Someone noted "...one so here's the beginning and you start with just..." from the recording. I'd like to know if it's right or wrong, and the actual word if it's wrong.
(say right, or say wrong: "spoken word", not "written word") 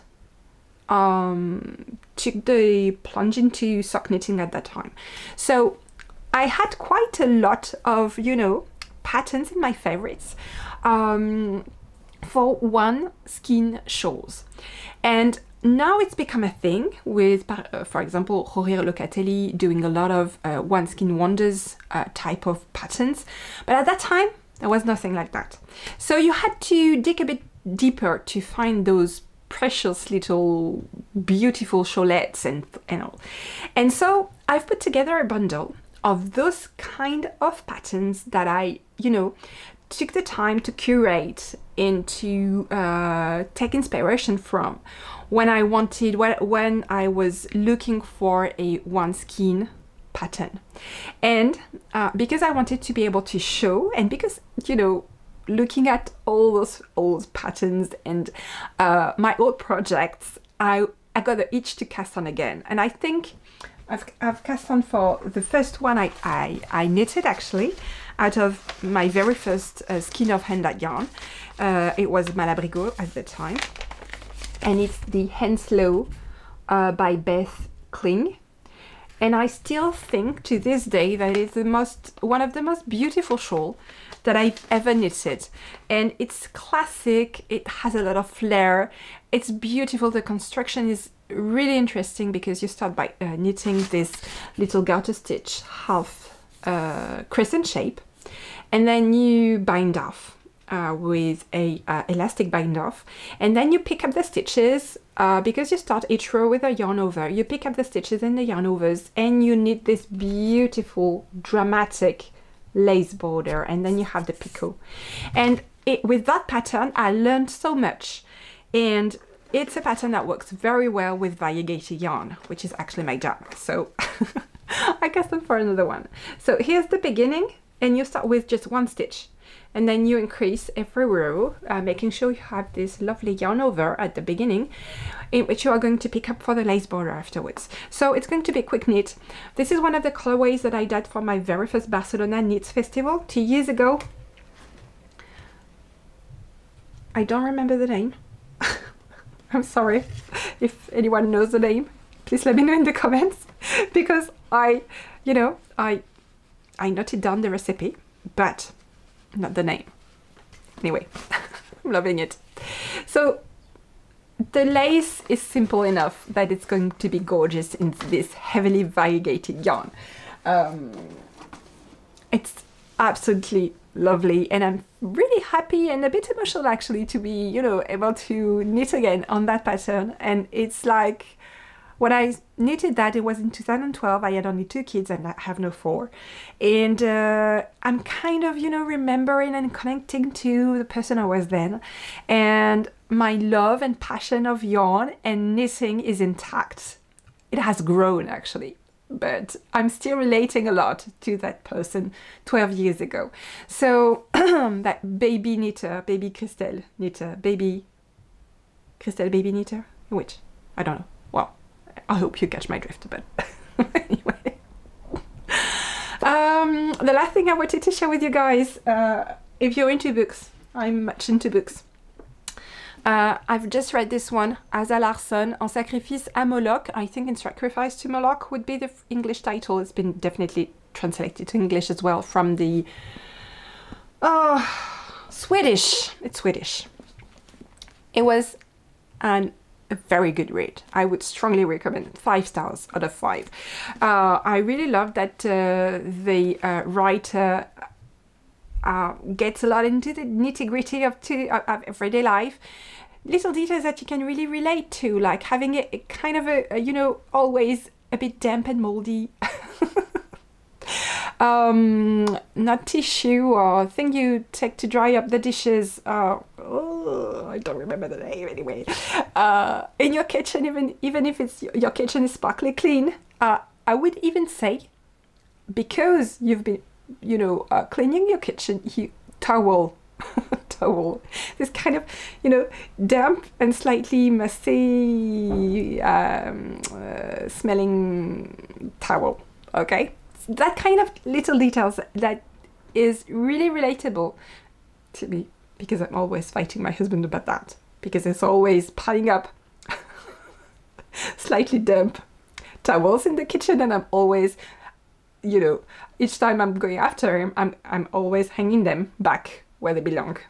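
right.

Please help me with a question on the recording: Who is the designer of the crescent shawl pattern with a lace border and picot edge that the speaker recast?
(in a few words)
Beth Kling.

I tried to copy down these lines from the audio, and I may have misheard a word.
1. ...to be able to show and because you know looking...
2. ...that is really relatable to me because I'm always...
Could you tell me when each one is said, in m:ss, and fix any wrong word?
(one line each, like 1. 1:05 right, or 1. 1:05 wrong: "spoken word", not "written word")
1. 0:52 right
2. 4:52 right.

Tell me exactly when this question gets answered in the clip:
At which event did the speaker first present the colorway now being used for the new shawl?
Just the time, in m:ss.
2:21.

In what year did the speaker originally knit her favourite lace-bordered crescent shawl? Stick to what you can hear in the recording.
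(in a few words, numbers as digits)
2012.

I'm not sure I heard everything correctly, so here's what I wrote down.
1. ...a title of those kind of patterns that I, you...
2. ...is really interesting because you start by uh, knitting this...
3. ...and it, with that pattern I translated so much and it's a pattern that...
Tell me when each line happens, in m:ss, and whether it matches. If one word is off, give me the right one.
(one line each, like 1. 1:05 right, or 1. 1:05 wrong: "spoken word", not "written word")
1. 0:35 wrong: "bundle", not "title"
2. 1:30 right
3. 1:55 wrong: "learned", not "translated".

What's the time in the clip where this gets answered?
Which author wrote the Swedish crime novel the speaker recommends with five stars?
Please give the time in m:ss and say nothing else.
3:44.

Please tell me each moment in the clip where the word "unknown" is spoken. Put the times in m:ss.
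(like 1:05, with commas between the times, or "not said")
not said.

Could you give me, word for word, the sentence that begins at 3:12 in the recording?
And my love and passion of yarn and knitting is intact.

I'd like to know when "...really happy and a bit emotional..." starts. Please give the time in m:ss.
2:55.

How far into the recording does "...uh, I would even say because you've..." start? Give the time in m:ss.
4:33.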